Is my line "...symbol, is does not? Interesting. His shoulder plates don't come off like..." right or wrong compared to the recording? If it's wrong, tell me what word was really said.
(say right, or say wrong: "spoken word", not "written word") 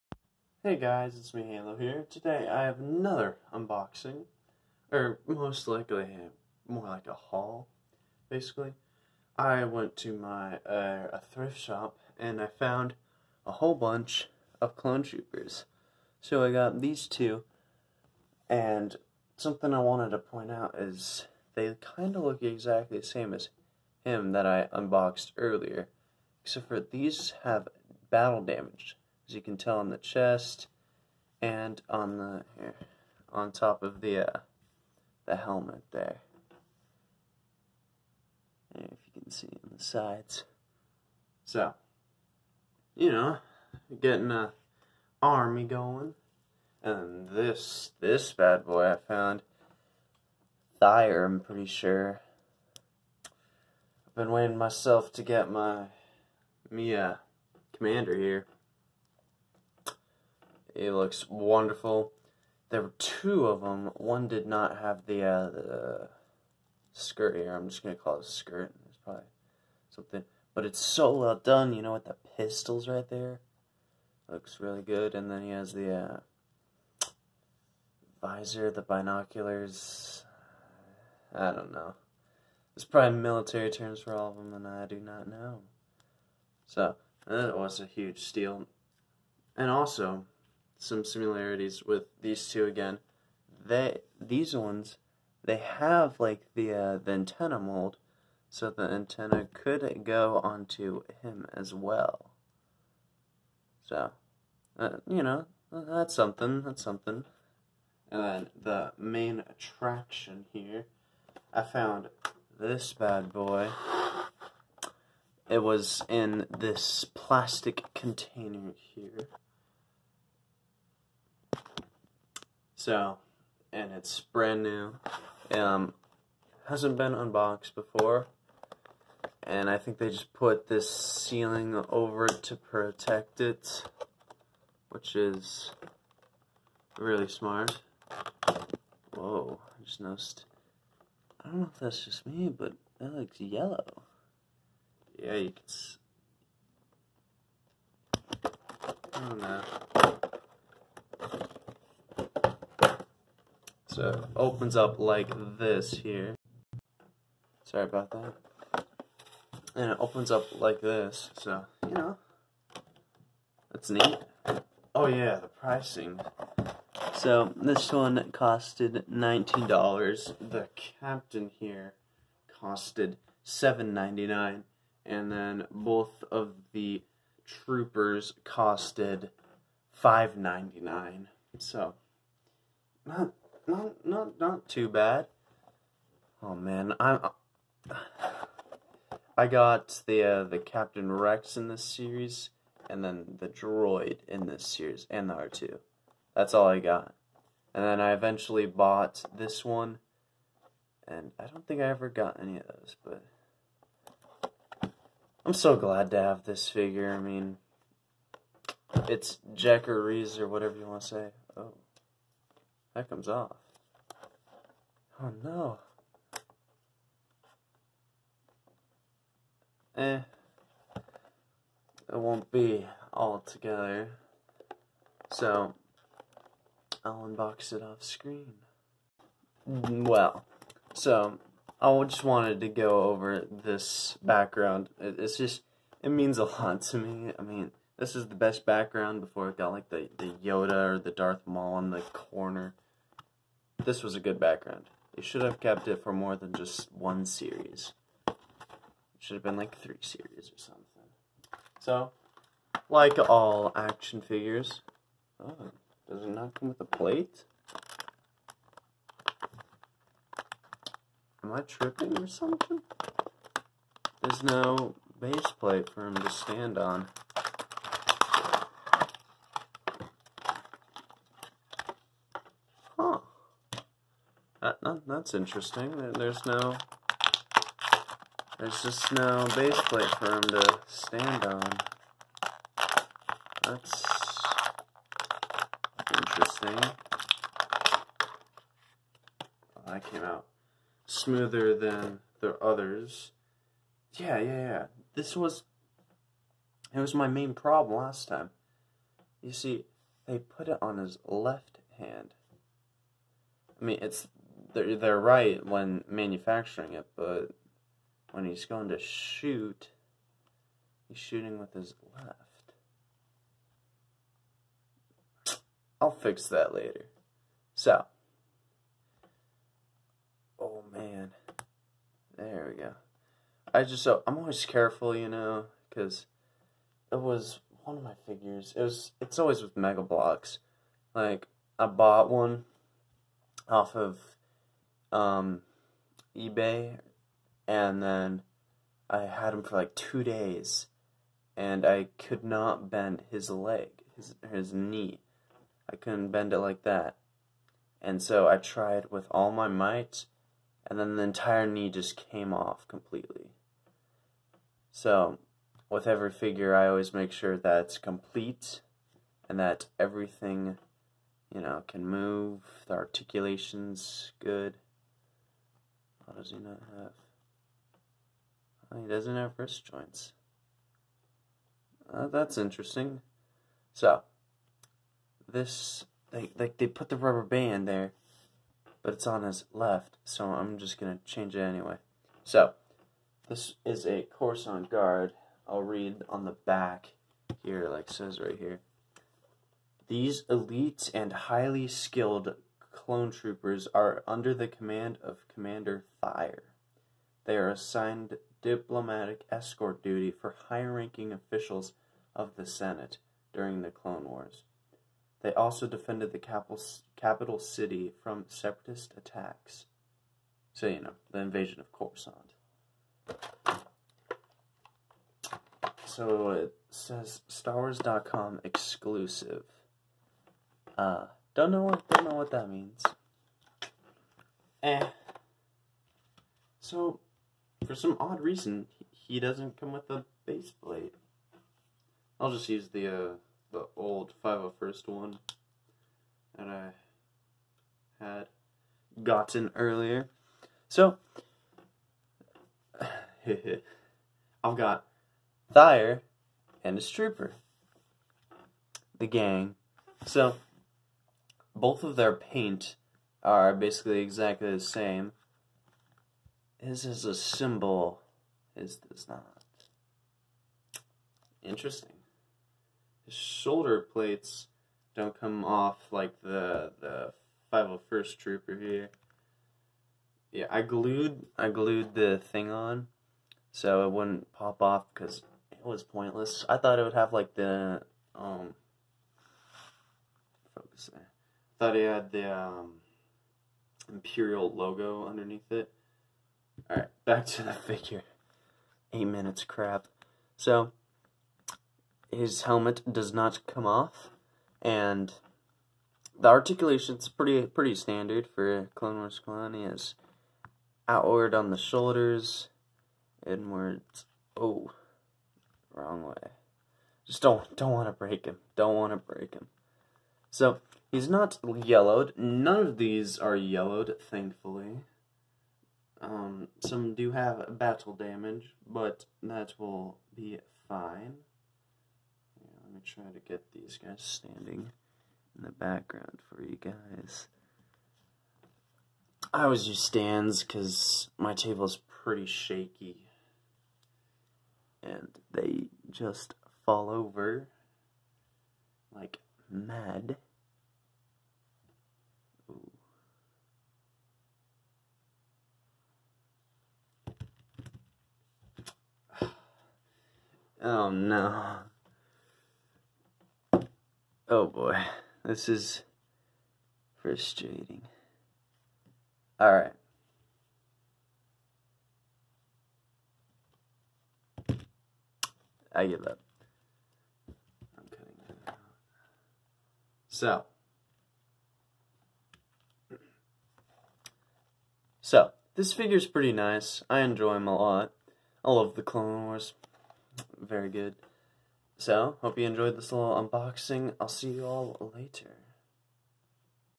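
right.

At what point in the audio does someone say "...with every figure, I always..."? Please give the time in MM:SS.
05:55.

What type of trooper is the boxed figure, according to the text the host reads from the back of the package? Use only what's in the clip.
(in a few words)
Coruscant Guard.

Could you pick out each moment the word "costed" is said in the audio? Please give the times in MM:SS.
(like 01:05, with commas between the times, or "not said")
02:48, 02:52, 02:58.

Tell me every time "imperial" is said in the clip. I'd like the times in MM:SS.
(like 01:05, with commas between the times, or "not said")
08:04.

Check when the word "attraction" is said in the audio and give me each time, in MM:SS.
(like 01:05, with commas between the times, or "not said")
01:49.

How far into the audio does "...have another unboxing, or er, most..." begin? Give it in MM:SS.
00:02.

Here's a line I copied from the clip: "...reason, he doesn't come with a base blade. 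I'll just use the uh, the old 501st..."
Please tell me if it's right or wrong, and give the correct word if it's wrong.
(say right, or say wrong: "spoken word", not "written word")
right.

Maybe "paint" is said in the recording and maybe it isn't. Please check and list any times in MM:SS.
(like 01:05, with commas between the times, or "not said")
07:32.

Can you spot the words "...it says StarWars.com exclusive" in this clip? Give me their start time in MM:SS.
06:56.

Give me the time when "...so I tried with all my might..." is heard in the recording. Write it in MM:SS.
05:48.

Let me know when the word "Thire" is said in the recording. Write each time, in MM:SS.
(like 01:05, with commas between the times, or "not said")
00:50, 06:36, 07:25.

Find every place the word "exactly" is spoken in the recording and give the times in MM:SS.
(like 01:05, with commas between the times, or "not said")
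00:22, 07:34.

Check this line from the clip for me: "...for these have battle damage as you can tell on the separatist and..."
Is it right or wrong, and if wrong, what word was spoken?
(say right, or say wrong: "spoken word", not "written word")
wrong: "chest", not "separatist".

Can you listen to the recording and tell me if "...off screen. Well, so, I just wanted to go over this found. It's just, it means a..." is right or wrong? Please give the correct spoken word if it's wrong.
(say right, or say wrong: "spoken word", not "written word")
wrong: "background", not "found".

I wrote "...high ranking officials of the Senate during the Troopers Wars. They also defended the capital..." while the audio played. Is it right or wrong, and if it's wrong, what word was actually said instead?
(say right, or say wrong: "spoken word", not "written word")
wrong: "Clone", not "Troopers".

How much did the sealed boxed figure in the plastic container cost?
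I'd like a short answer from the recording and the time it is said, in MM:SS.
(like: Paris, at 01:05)
$19, at 02:49.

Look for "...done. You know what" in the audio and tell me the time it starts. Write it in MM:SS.
01:11.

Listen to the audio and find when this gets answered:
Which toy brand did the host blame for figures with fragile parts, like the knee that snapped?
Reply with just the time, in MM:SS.
05:29.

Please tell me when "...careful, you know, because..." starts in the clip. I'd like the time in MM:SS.
05:24.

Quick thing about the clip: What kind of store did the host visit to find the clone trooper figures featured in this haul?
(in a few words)
Thrift shop.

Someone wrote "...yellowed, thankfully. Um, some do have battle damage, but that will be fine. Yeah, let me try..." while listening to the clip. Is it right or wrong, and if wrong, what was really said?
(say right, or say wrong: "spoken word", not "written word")
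right.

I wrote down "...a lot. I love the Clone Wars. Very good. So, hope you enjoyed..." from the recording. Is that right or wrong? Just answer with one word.
right.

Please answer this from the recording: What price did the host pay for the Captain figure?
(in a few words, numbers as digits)
$7.99.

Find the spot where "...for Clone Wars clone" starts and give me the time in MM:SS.
08:18.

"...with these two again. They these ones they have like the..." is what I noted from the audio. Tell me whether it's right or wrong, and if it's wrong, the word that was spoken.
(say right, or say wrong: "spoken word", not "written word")
right.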